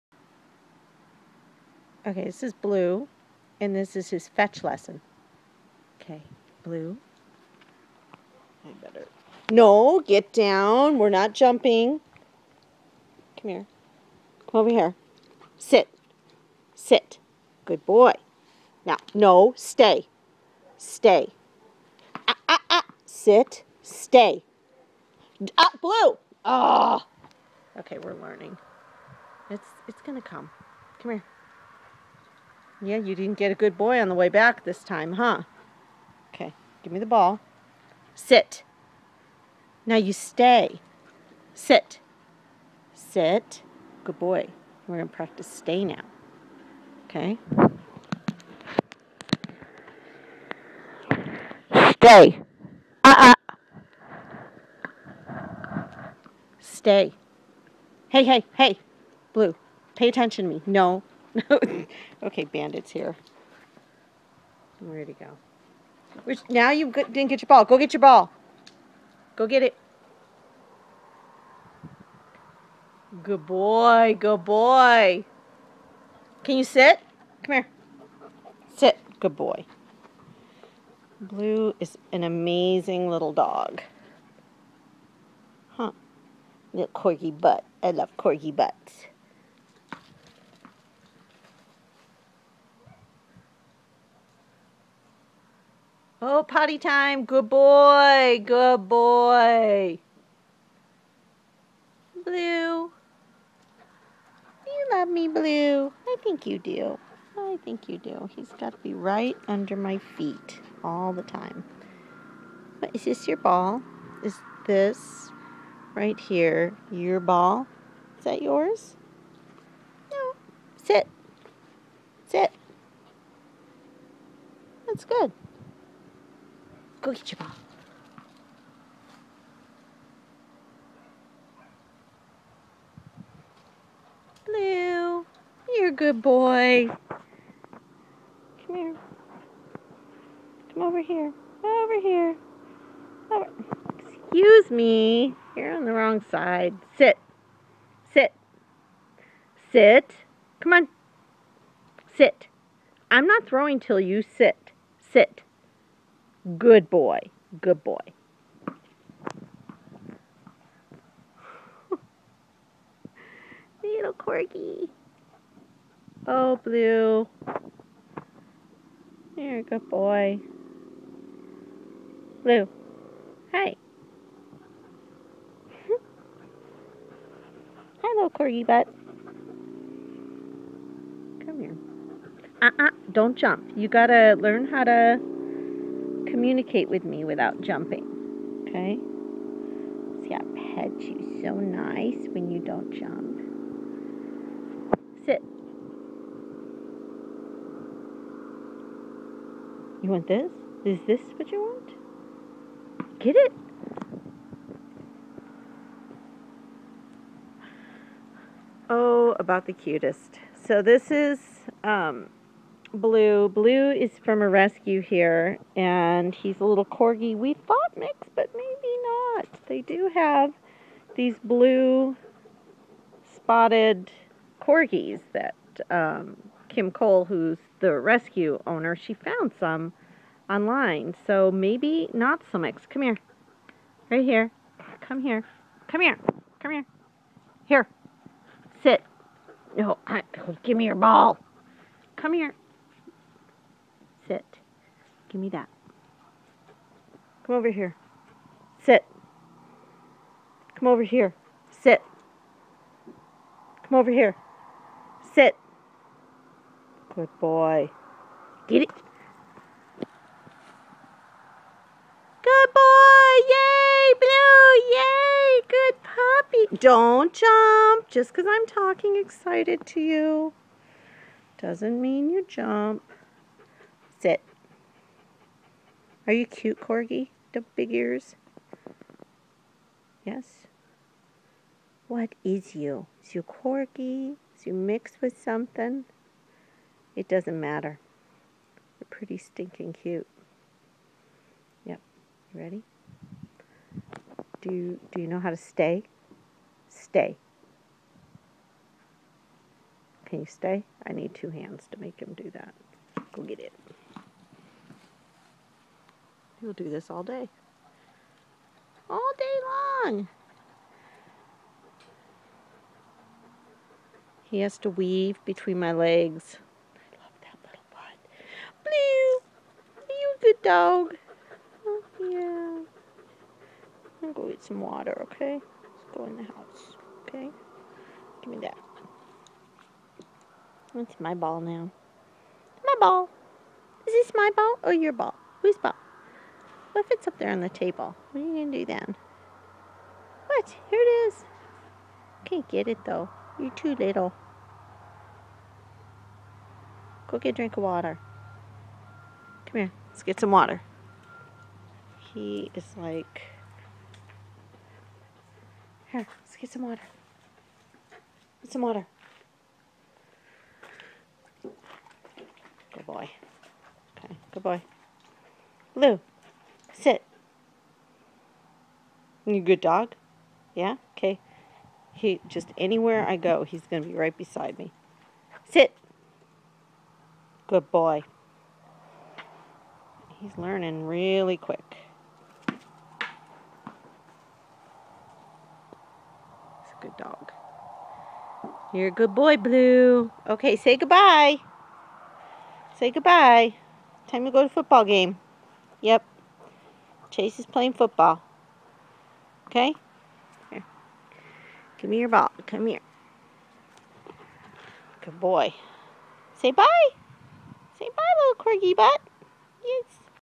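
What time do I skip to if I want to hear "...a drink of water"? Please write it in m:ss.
5:47.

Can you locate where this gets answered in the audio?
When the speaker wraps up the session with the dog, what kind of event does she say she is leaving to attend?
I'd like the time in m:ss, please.
6:34.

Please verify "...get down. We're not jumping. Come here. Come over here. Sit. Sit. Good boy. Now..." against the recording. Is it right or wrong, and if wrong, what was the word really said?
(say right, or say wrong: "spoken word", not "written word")
right.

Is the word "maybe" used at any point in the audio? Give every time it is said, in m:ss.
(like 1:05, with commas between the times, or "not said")
3:38, 3:51.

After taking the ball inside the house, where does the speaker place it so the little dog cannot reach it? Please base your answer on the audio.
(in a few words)
on the table.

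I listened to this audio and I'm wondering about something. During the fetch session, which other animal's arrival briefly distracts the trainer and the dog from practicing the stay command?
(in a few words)
Bandit.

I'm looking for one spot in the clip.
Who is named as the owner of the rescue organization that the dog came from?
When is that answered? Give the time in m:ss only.
3:46.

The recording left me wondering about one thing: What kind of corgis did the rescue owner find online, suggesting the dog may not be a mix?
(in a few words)
blue spotted corgis.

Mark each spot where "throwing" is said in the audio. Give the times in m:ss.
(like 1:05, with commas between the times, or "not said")
2:33.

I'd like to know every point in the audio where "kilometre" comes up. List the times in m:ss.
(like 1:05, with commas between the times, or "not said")
not said.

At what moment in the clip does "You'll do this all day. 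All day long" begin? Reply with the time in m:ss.
5:06.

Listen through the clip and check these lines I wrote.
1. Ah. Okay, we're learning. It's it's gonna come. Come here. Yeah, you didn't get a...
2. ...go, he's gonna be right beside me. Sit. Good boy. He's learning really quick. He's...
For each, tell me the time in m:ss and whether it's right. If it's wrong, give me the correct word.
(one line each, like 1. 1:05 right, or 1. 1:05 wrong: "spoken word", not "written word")
1. 0:26 right
2. 6:13 right.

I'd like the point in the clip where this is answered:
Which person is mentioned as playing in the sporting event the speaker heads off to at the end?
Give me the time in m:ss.
6:37.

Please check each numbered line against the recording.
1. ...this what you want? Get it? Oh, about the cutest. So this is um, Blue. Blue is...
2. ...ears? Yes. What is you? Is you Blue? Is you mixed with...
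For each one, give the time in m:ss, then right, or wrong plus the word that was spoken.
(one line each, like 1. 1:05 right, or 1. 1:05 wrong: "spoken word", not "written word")
1. 3:21 right
2. 4:37 wrong: "Corgi", not "Blue".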